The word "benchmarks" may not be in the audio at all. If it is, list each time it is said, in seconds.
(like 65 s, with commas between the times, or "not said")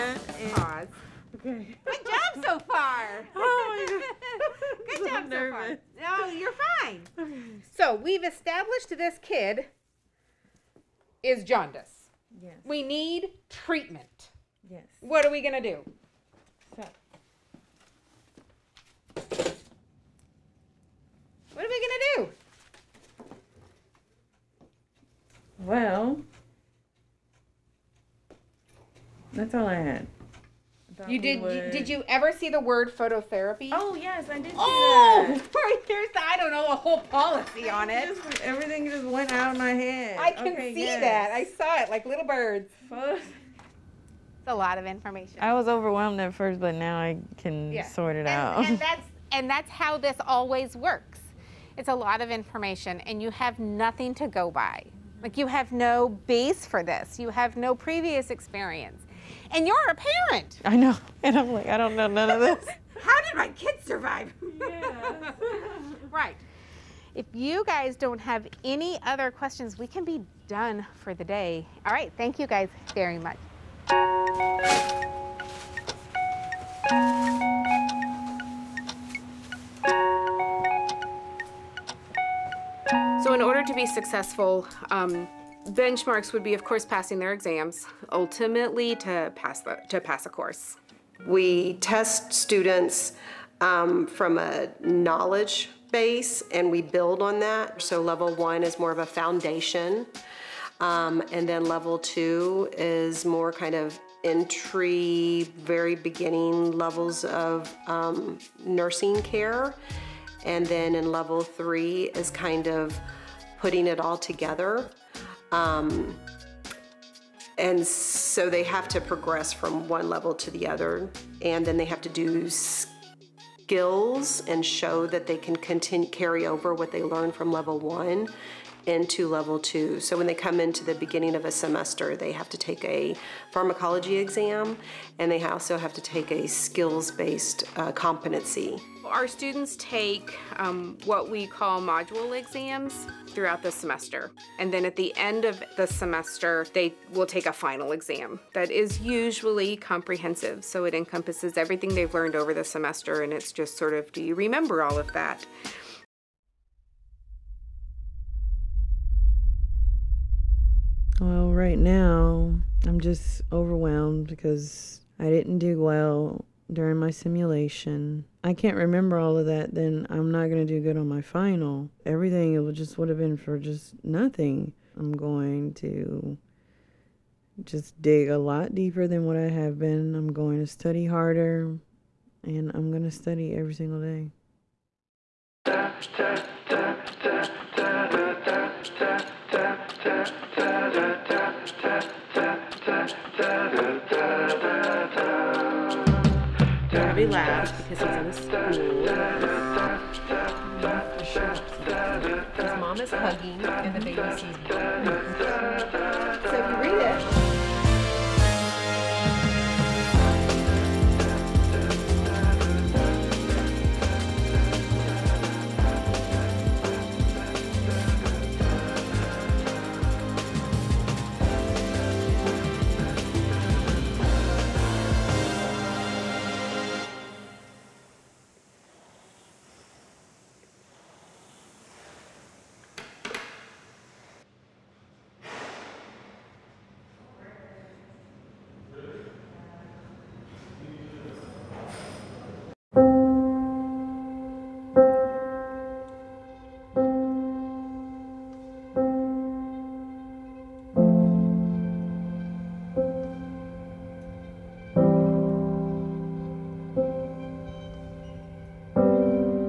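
85 s.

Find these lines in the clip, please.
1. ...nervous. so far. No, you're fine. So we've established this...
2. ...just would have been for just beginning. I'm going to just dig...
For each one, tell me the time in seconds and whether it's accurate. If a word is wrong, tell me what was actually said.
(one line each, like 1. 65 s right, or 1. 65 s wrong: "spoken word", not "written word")
1. 5 s right
2. 172 s wrong: "nothing", not "beginning".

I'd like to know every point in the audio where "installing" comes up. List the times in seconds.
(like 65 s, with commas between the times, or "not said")
not said.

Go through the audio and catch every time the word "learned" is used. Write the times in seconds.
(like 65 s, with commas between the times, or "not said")
127 s, 152 s.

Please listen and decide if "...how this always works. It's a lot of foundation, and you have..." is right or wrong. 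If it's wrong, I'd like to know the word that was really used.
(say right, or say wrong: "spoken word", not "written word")
wrong: "information", not "foundation".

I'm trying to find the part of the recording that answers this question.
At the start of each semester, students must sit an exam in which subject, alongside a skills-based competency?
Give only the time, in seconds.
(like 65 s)
133 s.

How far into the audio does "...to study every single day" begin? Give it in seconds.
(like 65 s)
183 s.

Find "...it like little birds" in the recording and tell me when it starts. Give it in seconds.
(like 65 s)
41 s.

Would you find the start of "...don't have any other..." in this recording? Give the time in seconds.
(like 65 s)
67 s.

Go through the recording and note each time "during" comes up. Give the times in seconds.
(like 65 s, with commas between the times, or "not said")
166 s.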